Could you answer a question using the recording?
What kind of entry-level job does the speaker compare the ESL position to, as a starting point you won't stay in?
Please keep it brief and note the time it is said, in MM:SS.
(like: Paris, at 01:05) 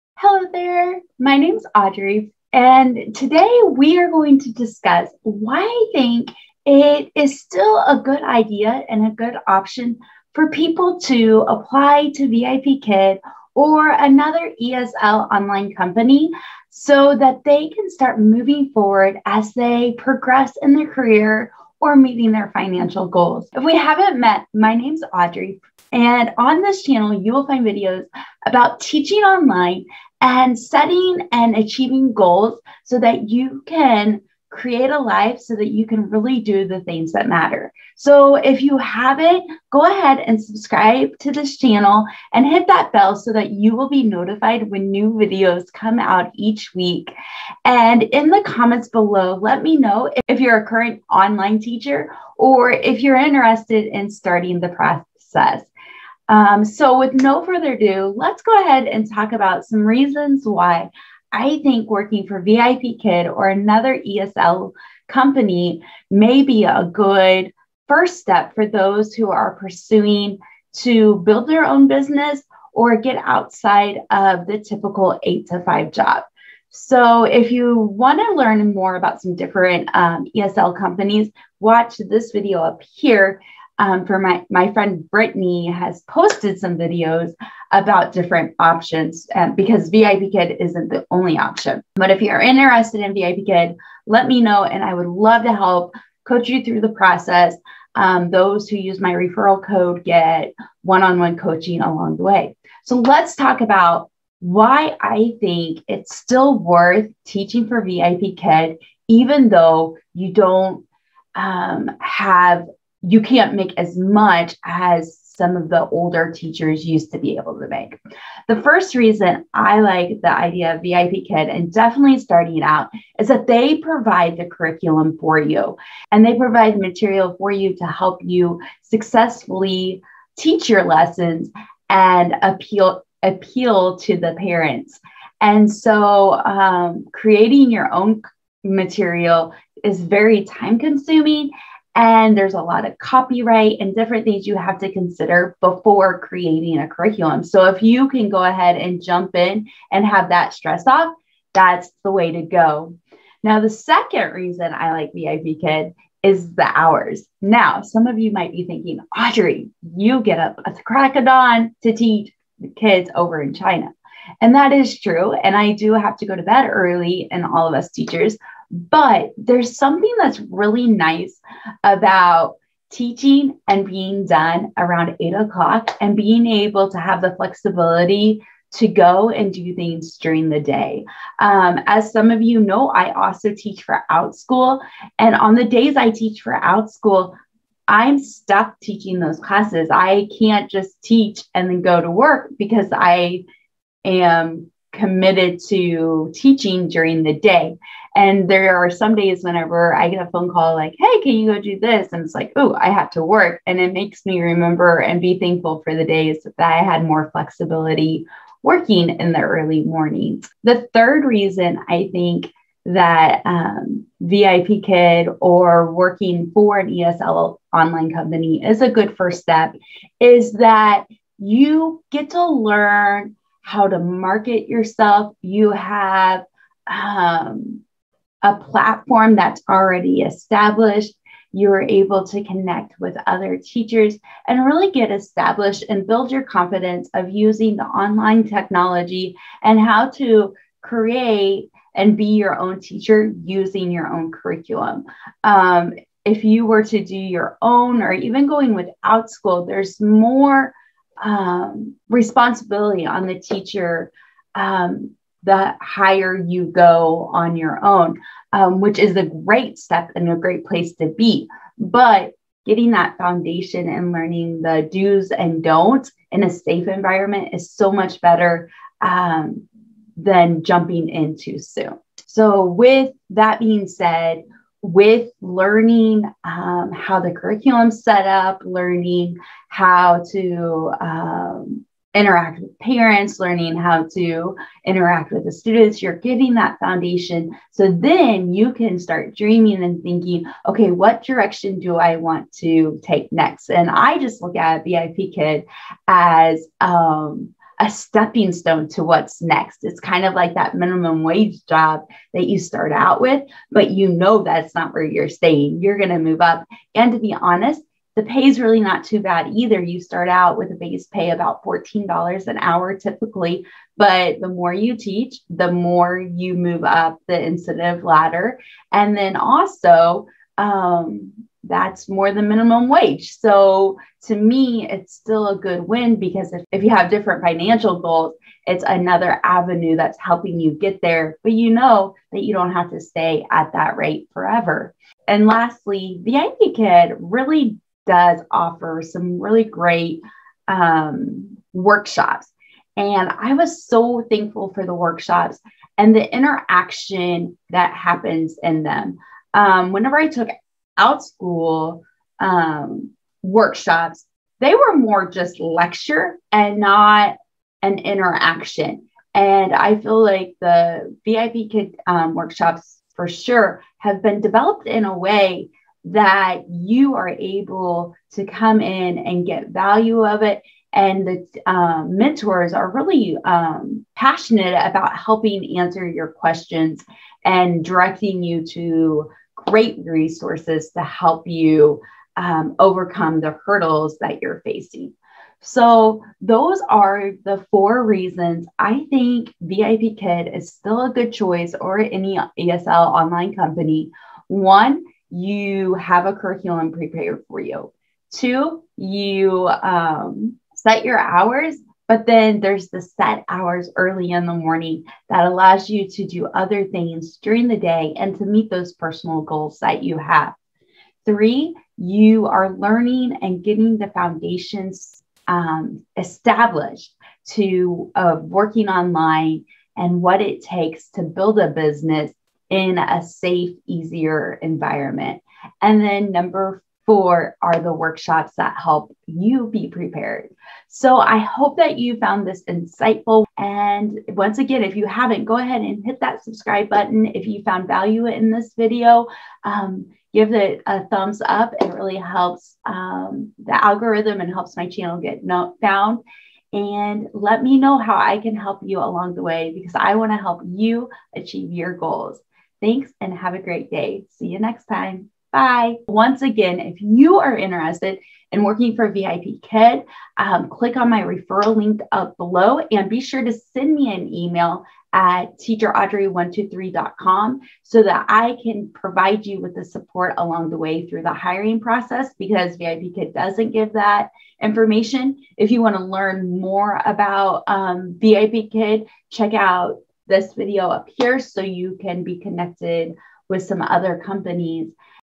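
minimum wage job, at 05:00.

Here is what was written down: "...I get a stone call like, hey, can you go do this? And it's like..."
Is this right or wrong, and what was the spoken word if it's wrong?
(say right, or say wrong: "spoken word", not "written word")
wrong: "phone", not "stone".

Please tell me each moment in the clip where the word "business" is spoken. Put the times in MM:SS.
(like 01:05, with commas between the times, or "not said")
01:11, 07:01.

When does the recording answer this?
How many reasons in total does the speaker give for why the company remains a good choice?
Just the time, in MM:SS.
06:27.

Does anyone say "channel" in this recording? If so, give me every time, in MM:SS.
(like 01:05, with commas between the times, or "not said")
00:26, 00:41, 07:24.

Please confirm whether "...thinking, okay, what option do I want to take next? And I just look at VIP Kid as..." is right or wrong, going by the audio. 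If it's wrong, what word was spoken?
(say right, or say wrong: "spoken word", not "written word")
wrong: "direction", not "option".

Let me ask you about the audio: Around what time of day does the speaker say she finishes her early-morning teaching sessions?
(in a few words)
8 o'clock.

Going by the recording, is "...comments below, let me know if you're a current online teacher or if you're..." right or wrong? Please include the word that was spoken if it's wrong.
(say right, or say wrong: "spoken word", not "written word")
right.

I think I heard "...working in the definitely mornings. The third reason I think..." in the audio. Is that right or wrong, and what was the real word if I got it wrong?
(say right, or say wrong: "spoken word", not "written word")
wrong: "early", not "definitely".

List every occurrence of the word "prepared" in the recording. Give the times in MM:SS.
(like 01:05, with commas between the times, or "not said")
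06:36, 07:09.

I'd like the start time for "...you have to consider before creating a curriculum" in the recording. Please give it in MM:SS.
02:24.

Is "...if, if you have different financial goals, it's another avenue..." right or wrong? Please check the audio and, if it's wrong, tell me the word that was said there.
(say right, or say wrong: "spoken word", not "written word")
right.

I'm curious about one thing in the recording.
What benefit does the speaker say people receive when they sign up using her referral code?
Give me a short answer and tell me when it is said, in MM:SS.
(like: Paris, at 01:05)
one-on-one coaching, at 01:40.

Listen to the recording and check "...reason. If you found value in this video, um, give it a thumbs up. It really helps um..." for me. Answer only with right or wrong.
wrong.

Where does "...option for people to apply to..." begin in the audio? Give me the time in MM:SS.
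00:09.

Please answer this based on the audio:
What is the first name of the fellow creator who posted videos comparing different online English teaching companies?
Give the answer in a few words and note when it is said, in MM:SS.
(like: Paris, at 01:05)
Brittany, at 01:25.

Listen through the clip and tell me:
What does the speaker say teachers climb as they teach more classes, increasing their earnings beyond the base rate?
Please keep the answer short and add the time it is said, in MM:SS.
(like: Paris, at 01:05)
incentive ladder, at 05:17.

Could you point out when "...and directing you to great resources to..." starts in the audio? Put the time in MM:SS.
06:17.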